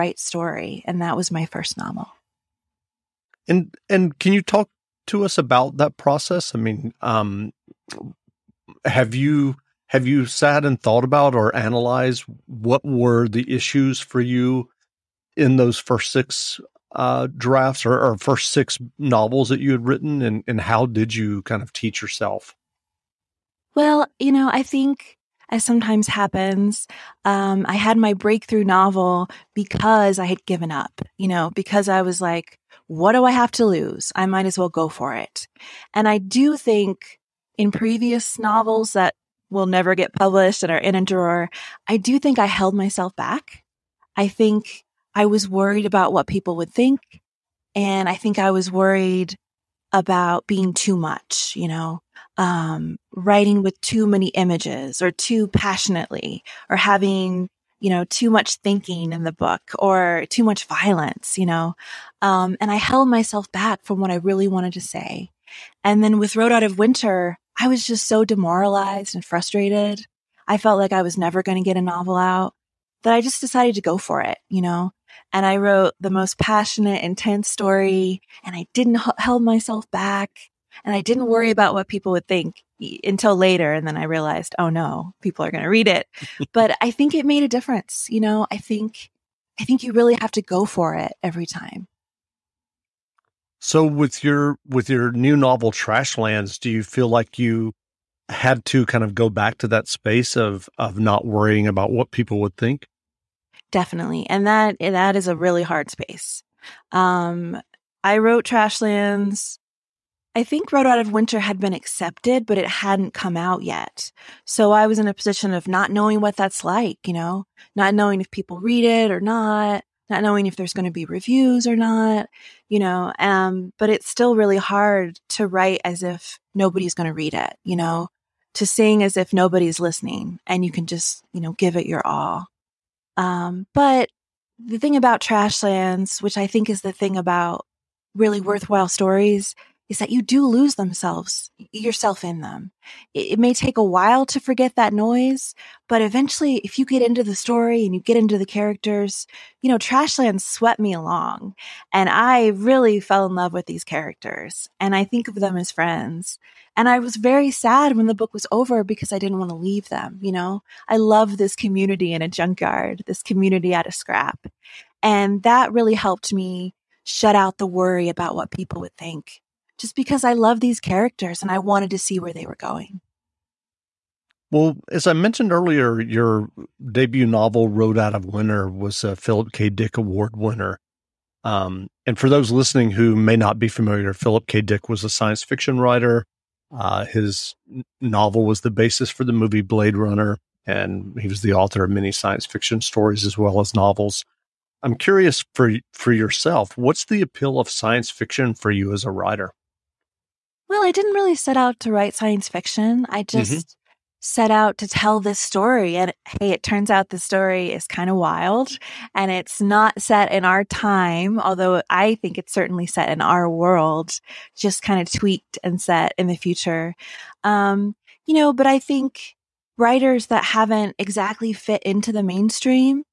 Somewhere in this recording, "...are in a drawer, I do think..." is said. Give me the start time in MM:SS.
00:40.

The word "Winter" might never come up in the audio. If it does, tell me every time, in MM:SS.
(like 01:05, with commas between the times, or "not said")
01:06, 01:51, 02:58.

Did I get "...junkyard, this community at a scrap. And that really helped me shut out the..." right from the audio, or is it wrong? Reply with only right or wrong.
right.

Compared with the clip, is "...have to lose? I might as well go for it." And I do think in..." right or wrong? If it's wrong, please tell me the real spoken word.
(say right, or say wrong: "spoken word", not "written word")
right.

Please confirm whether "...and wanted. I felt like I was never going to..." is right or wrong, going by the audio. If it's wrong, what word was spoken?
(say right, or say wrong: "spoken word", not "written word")
wrong: "frustrated", not "wanted".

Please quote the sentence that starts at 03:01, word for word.
Um, and for those listening who may not be familiar, Philip K.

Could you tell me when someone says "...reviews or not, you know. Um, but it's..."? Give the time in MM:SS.
02:01.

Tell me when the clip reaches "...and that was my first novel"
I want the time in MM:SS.
00:00.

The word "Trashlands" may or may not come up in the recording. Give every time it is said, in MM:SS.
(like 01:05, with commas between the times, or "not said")
01:35, 01:48, 02:15, 02:29.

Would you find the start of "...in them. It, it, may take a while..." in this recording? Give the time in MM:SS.
02:22.